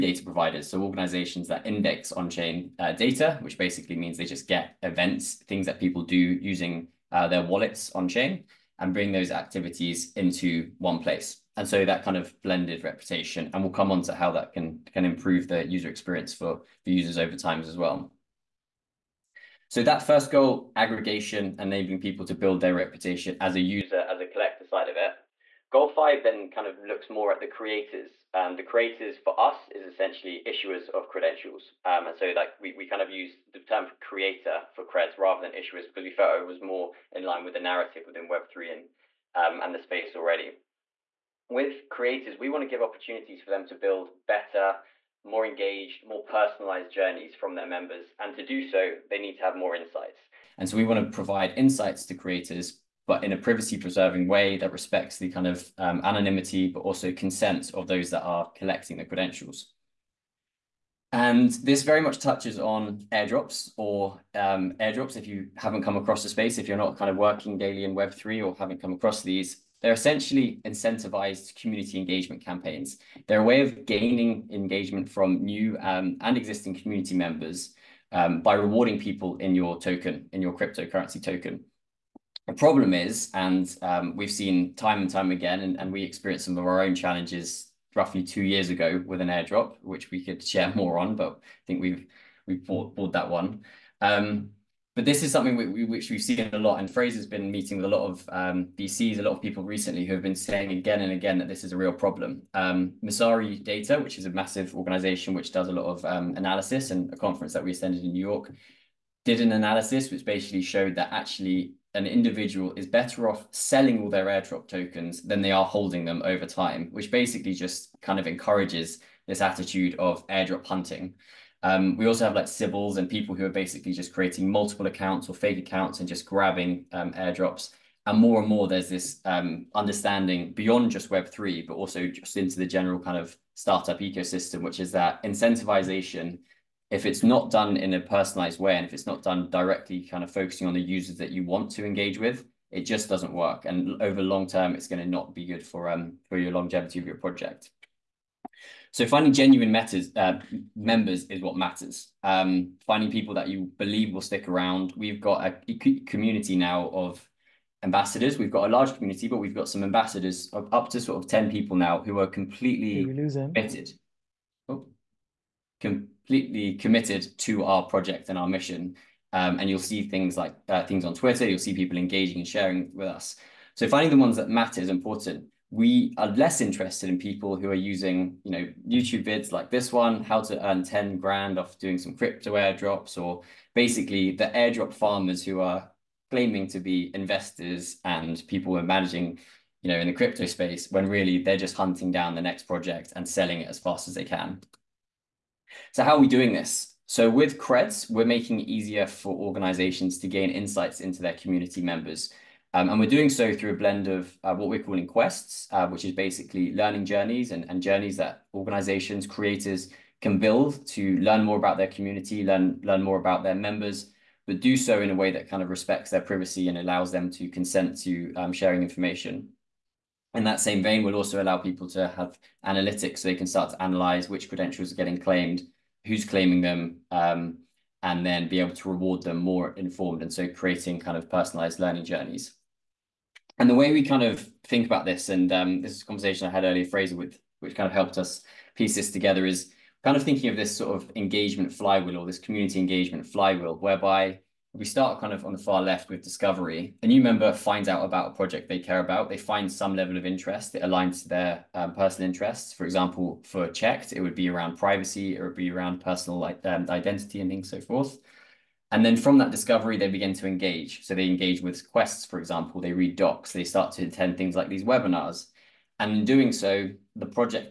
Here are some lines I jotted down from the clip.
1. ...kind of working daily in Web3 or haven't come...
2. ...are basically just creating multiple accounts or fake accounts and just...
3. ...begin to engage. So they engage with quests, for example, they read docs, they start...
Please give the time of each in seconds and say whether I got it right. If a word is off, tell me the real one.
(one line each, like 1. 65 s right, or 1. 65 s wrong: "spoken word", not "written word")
1. 66 s right
2. 123 s right
3. 260 s right.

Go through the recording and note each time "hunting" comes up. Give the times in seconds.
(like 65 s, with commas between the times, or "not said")
120 s, 191 s.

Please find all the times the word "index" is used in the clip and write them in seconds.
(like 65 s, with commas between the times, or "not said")
1 s.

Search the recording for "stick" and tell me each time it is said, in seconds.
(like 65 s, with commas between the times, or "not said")
154 s.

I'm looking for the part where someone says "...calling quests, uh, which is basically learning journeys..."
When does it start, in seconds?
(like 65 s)
204 s.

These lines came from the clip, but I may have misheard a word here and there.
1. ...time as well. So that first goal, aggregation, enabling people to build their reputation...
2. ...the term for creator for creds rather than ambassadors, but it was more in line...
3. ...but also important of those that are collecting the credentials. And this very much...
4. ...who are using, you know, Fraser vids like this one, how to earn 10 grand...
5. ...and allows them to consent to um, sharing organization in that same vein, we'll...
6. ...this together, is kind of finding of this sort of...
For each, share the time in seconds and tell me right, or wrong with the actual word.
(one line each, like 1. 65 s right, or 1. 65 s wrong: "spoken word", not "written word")
1. 17 s right
2. 33 s wrong: "issuers", not "ambassadors"
3. 56 s wrong: "consent", not "important"
4. 177 s wrong: "YouTube", not "Fraser"
5. 216 s wrong: "information", not "organization"
6. 238 s wrong: "thinking", not "finding".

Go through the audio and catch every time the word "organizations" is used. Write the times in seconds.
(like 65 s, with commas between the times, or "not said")
0 s, 104 s, 199 s, 208 s.